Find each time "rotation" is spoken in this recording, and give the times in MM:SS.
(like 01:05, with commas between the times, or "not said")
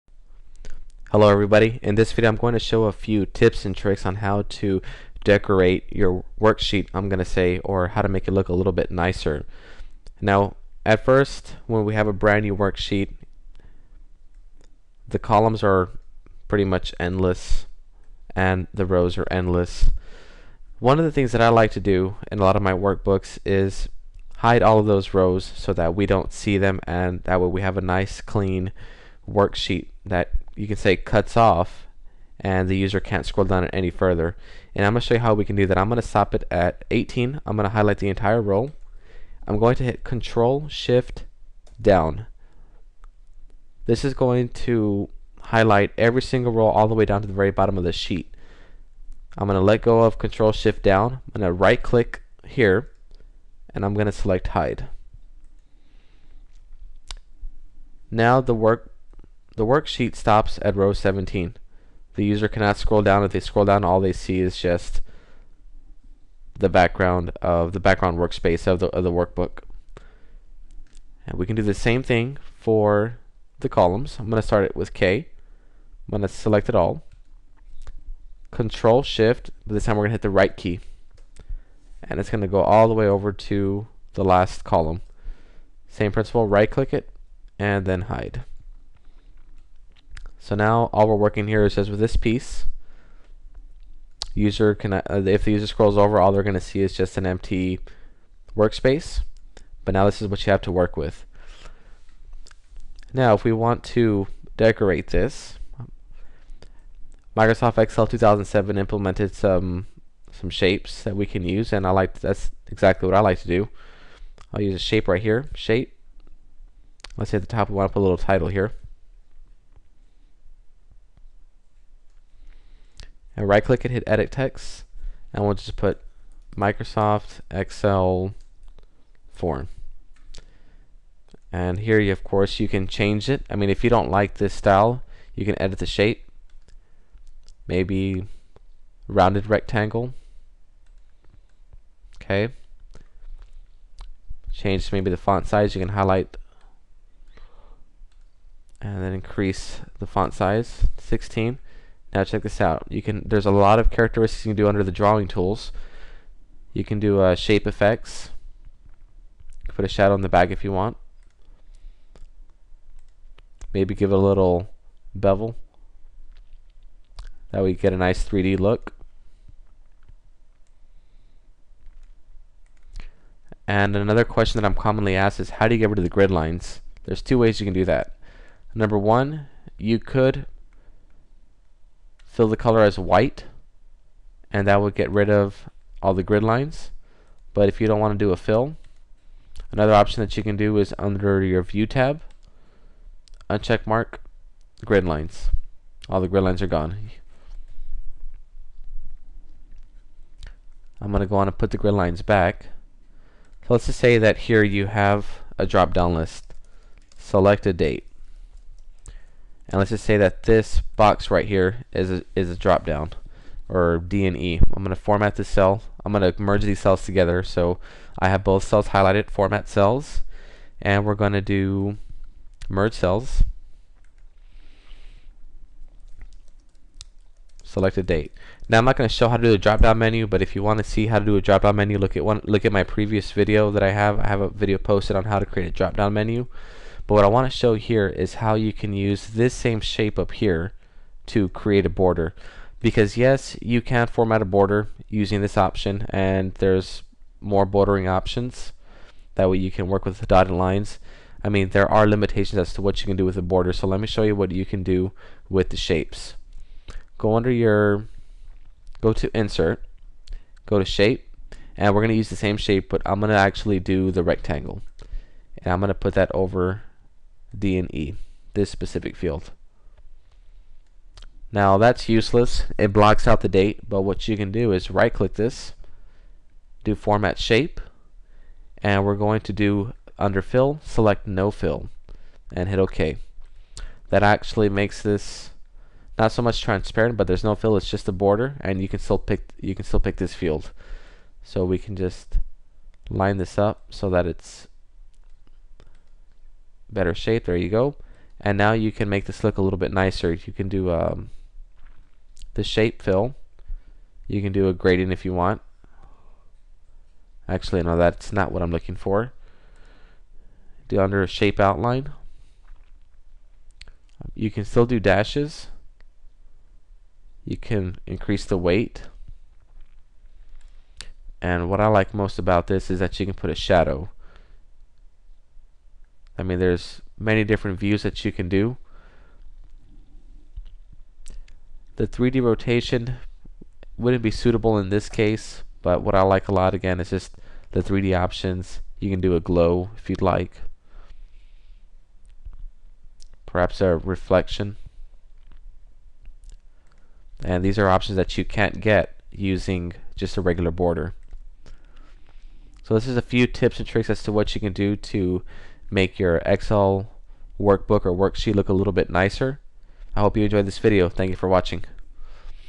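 05:32.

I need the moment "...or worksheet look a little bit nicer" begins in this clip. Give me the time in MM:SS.
05:58.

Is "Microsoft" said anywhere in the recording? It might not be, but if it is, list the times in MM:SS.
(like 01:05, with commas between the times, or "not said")
01:47, 02:06.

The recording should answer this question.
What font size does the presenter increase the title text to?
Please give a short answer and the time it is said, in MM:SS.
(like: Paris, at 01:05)
16, at 02:30.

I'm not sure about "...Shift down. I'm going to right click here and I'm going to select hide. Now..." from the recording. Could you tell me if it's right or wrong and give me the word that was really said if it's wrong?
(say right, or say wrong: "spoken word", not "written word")
right.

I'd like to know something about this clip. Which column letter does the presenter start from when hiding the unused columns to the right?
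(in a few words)
K.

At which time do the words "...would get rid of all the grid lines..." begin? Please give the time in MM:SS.
03:04.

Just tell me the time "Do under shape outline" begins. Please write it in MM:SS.
05:10.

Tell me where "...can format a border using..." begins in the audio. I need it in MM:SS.
04:03.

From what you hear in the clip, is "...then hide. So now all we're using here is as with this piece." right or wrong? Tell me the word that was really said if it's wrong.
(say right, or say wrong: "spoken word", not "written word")
wrong: "working", not "using".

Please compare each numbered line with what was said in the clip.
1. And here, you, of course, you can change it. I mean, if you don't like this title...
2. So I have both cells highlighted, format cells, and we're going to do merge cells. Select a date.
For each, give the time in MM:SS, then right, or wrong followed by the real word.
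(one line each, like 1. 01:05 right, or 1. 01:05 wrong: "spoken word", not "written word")
1. 02:11 wrong: "style", not "title"
2. 03:37 right.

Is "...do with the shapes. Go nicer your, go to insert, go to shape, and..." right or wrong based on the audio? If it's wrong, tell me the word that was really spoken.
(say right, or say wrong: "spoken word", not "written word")
wrong: "under", not "nicer".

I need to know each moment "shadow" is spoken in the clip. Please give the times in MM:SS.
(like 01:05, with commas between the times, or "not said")
02:39, 05:23.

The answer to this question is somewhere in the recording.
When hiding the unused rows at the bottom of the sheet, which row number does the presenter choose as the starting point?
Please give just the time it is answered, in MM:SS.
00:36.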